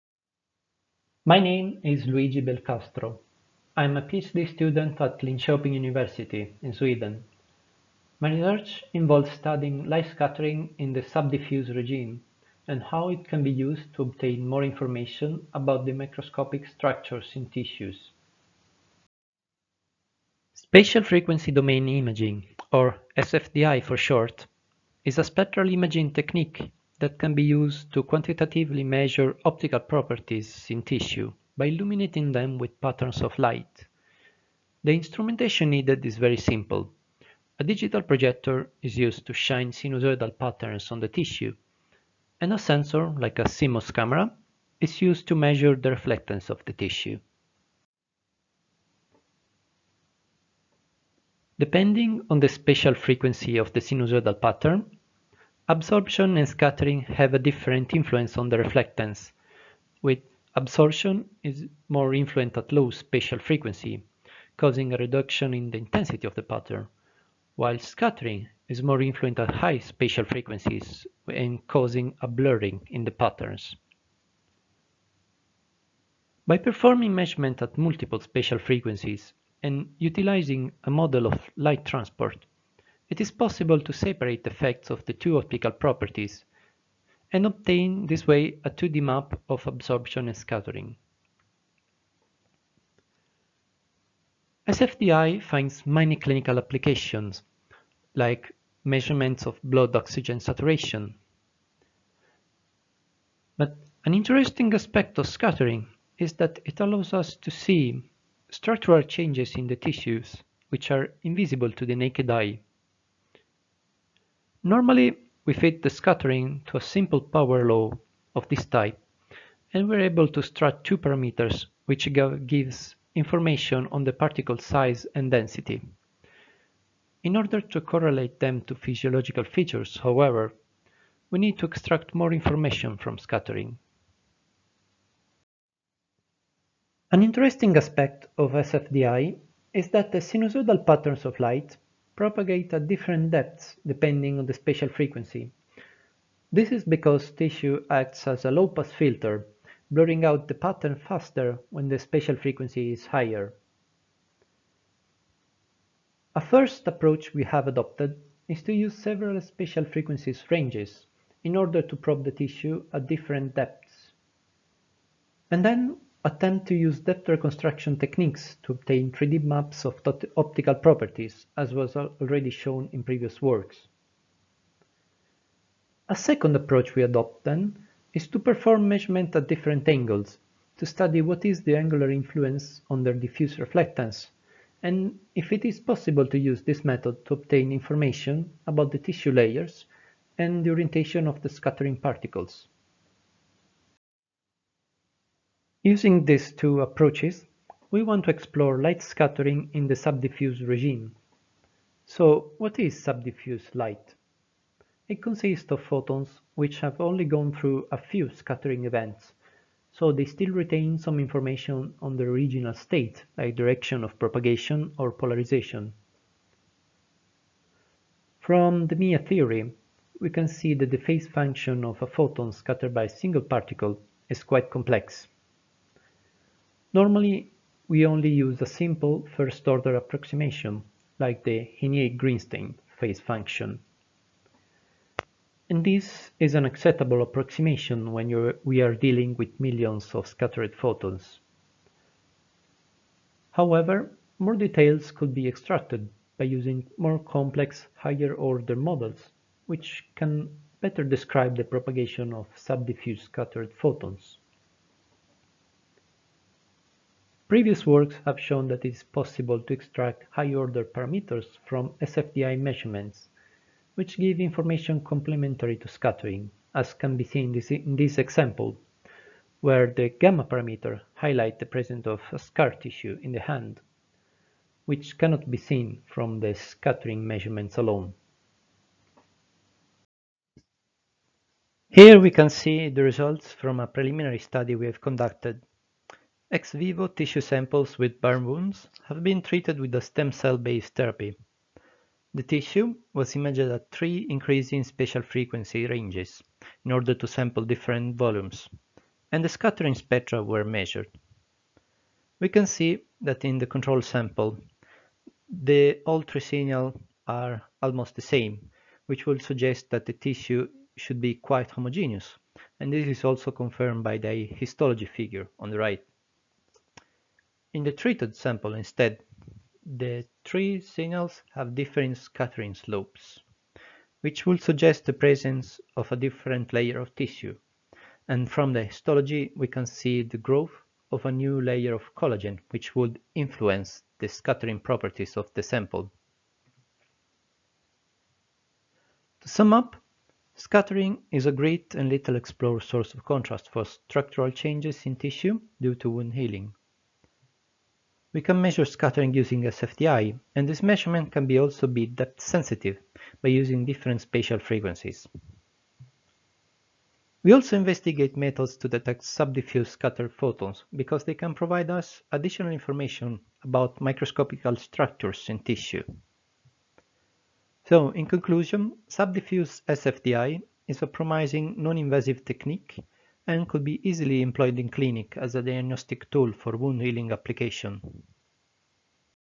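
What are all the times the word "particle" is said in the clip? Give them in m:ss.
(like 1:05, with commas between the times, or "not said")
2:04, 3:11, 3:43.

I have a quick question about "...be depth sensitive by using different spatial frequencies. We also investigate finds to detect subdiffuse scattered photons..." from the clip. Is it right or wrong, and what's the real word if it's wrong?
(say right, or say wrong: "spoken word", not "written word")
wrong: "methods", not "finds".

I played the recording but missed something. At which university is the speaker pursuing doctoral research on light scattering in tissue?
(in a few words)
Linköping University.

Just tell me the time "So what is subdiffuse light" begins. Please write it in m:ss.
3:22.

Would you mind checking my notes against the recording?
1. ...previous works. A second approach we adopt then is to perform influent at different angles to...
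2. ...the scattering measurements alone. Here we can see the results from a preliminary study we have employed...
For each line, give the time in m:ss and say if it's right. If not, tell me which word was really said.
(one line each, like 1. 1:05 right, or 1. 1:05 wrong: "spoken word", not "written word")
1. 2:53 wrong: "measurement", not "influent"
2. 4:36 wrong: "conducted", not "employed".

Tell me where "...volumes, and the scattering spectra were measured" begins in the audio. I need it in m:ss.
4:58.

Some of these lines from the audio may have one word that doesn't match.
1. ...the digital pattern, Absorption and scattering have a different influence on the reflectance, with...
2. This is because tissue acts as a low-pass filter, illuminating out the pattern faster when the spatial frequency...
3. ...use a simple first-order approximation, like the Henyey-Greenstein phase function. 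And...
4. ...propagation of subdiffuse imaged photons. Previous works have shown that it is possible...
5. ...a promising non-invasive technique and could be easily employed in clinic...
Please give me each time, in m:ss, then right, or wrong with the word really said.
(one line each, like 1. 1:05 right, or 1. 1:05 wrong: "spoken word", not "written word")
1. 0:53 wrong: "sinusoidal", not "digital"
2. 2:26 wrong: "blurring", not "illuminating"
3. 3:48 right
4. 4:11 wrong: "scattered", not "imaged"
5. 6:11 right.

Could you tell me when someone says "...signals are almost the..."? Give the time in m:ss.
5:06.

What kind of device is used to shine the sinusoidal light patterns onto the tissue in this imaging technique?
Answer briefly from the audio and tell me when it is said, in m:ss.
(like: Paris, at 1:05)
digital projector, at 0:37.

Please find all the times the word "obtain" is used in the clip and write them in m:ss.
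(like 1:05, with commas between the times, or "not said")
0:14, 1:27, 2:48, 3:07.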